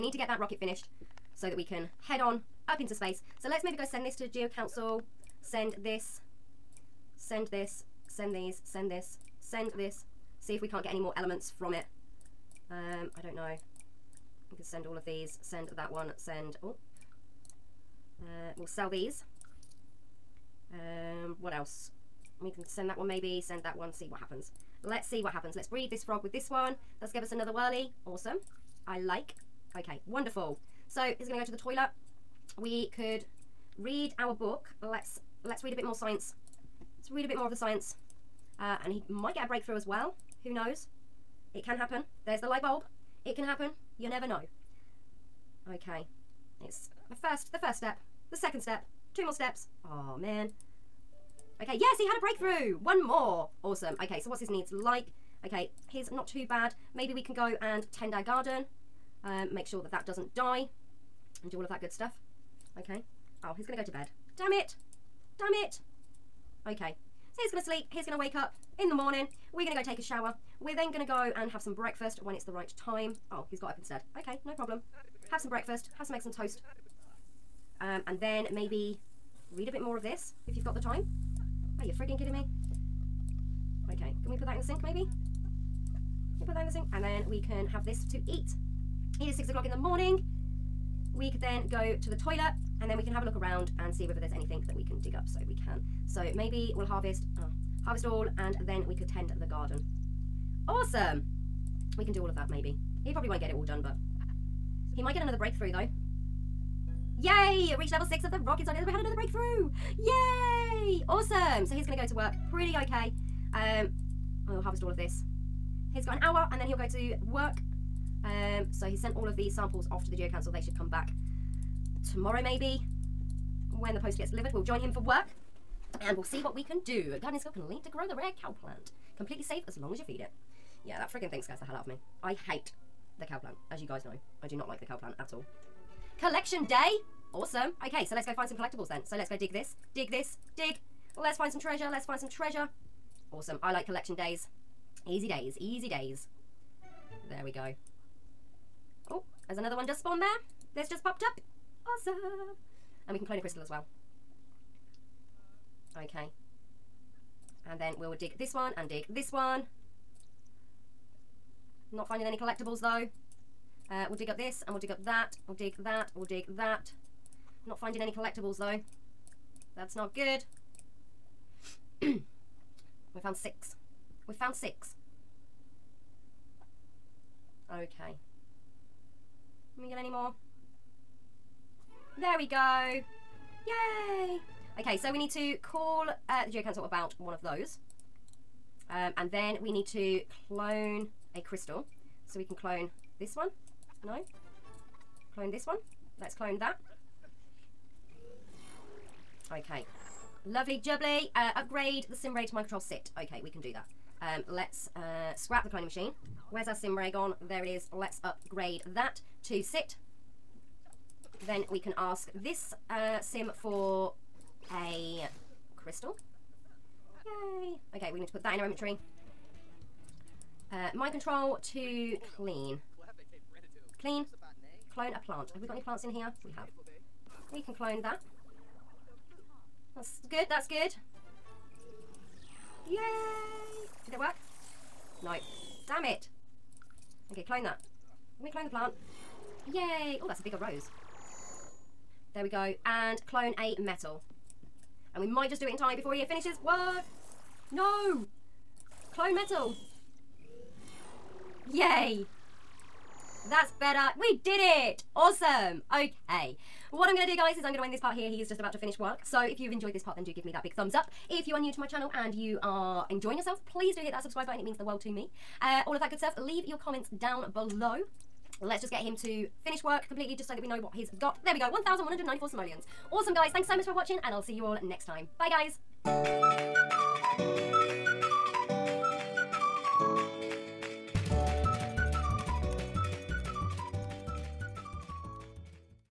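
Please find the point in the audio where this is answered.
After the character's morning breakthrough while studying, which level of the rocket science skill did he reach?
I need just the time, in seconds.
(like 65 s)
107 s.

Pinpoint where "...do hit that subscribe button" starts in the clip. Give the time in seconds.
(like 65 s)
263 s.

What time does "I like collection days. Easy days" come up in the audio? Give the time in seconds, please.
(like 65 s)
143 s.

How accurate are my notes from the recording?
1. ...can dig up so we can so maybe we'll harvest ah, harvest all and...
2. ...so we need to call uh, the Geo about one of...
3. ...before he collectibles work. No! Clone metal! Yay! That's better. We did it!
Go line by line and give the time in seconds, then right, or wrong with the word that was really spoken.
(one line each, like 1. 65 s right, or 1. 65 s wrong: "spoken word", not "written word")
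1. 94 s right
2. 184 s wrong: "Council", not "Geo"
3. 245 s wrong: "finishes", not "collectibles".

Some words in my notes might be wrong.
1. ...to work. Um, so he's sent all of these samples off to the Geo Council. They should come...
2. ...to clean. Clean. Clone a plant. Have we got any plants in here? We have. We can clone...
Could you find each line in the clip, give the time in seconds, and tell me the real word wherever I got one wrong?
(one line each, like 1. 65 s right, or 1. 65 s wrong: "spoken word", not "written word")
1. 116 s right
2. 221 s right.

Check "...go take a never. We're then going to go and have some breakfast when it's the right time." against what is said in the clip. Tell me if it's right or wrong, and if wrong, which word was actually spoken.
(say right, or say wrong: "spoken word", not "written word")
wrong: "shower", not "never".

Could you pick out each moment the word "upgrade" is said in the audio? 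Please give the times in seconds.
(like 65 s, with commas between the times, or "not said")
201 s, 208 s.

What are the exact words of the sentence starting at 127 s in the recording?
Gardening skill can lead to grow the rare cow plant.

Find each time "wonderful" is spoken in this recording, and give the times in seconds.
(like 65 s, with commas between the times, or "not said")
30 s.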